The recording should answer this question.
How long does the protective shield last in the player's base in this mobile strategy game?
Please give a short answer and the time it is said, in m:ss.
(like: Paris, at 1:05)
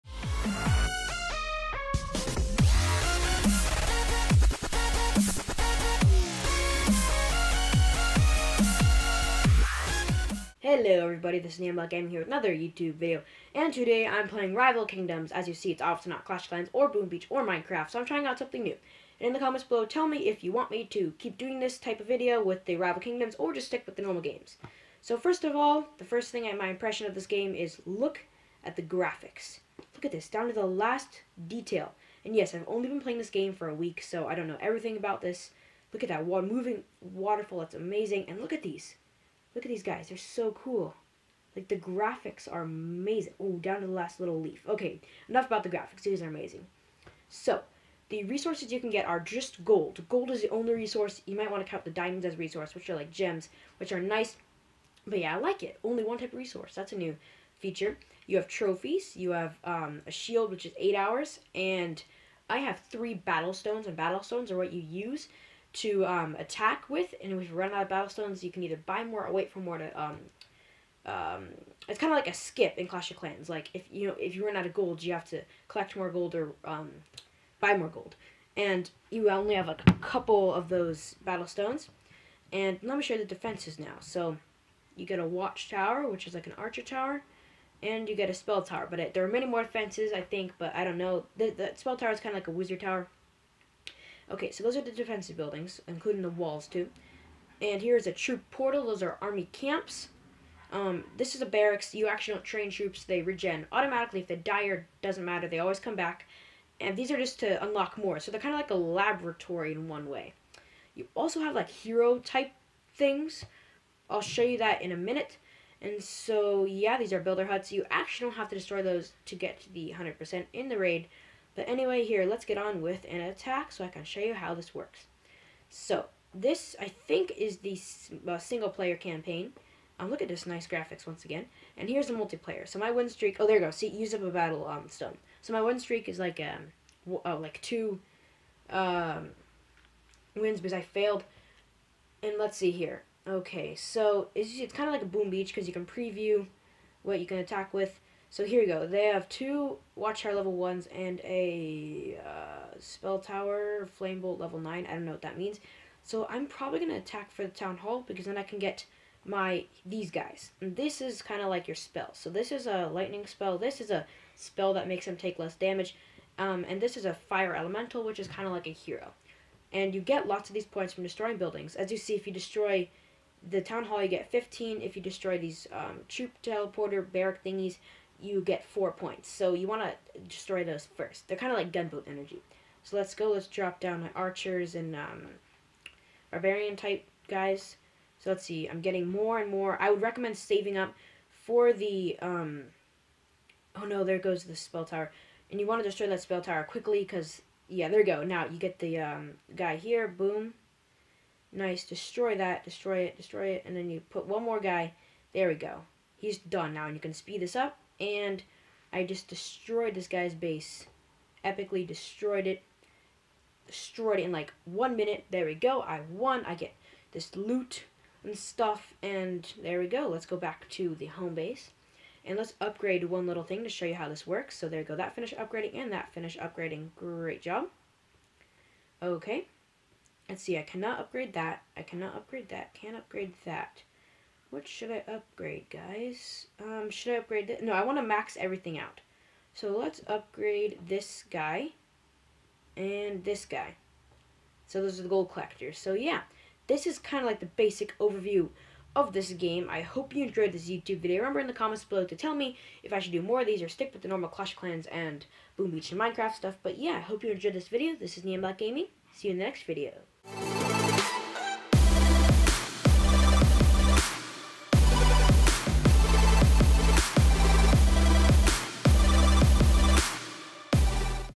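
8 hours, at 1:00.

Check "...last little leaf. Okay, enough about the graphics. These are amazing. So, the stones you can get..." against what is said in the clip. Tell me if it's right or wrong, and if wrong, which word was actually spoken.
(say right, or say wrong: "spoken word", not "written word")
wrong: "resources", not "stones".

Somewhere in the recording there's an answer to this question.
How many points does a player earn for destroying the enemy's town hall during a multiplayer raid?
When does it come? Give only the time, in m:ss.
2:54.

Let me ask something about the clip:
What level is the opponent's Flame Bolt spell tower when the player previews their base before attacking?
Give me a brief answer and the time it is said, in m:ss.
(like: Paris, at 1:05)
9, at 2:34.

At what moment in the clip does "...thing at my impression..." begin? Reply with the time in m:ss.
0:26.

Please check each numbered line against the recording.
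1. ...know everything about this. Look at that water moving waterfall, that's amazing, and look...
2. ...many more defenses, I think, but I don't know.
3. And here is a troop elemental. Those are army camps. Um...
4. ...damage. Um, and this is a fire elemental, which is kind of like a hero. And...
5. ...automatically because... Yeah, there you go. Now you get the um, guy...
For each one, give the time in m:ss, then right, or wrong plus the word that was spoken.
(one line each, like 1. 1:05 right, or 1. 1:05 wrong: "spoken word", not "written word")
1. 0:34 right
2. 1:29 right
3. 1:37 wrong: "portal", not "elemental"
4. 2:45 right
5. 3:16 wrong: "quickly", not "automatically".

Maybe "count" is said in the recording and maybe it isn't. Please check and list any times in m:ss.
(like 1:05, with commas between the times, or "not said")
0:51.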